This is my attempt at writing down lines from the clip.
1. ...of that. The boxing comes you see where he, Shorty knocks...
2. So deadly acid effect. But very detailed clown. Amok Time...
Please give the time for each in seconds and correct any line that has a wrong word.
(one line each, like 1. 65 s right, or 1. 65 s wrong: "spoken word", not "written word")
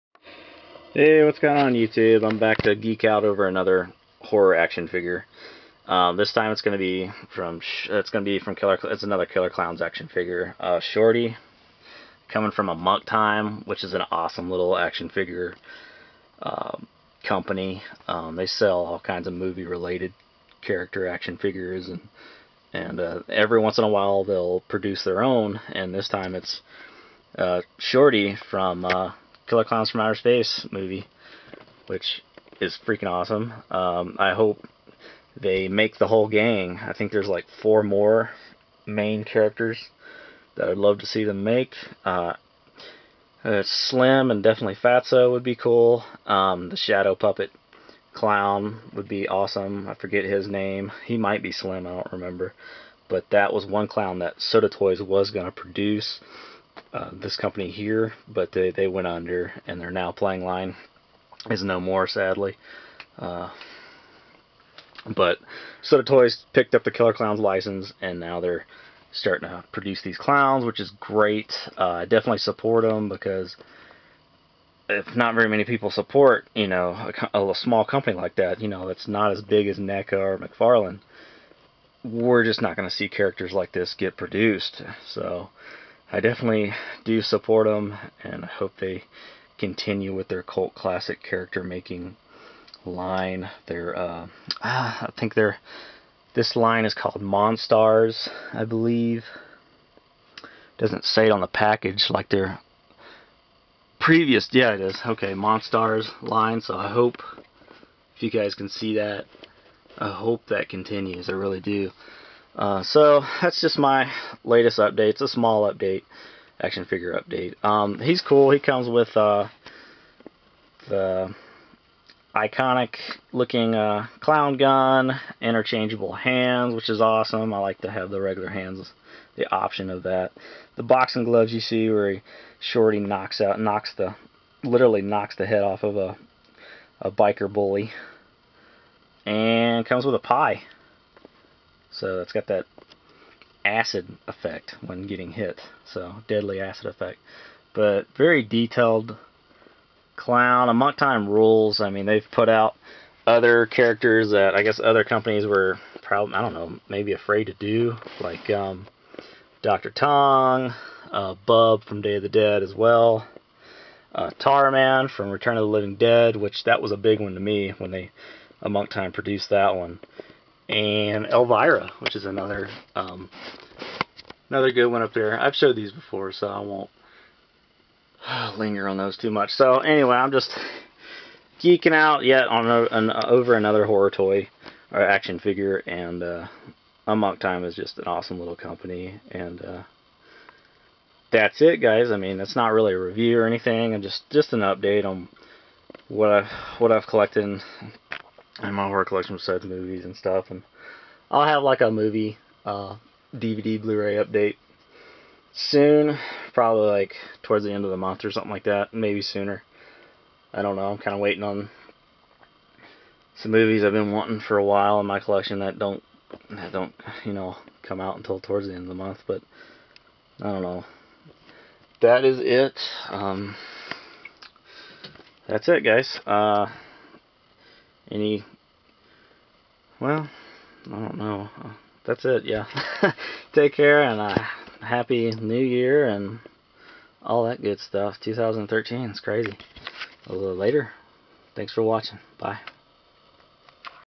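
1. 129 s wrong: "gloves", not "comes"
2. 145 s right.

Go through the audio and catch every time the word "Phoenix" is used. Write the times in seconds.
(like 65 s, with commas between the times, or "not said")
not said.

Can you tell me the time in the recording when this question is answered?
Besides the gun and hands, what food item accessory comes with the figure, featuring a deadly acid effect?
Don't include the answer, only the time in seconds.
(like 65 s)
140 s.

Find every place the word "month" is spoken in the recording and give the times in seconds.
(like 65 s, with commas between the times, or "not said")
207 s, 218 s.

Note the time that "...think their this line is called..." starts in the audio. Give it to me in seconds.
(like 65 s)
95 s.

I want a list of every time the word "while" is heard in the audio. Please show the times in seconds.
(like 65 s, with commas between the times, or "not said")
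23 s, 214 s.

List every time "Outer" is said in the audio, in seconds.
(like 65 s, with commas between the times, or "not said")
29 s.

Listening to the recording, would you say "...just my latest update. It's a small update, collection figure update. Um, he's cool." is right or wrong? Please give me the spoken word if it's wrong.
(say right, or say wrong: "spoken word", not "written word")
wrong: "action", not "collection".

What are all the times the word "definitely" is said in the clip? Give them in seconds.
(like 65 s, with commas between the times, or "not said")
44 s, 72 s, 86 s.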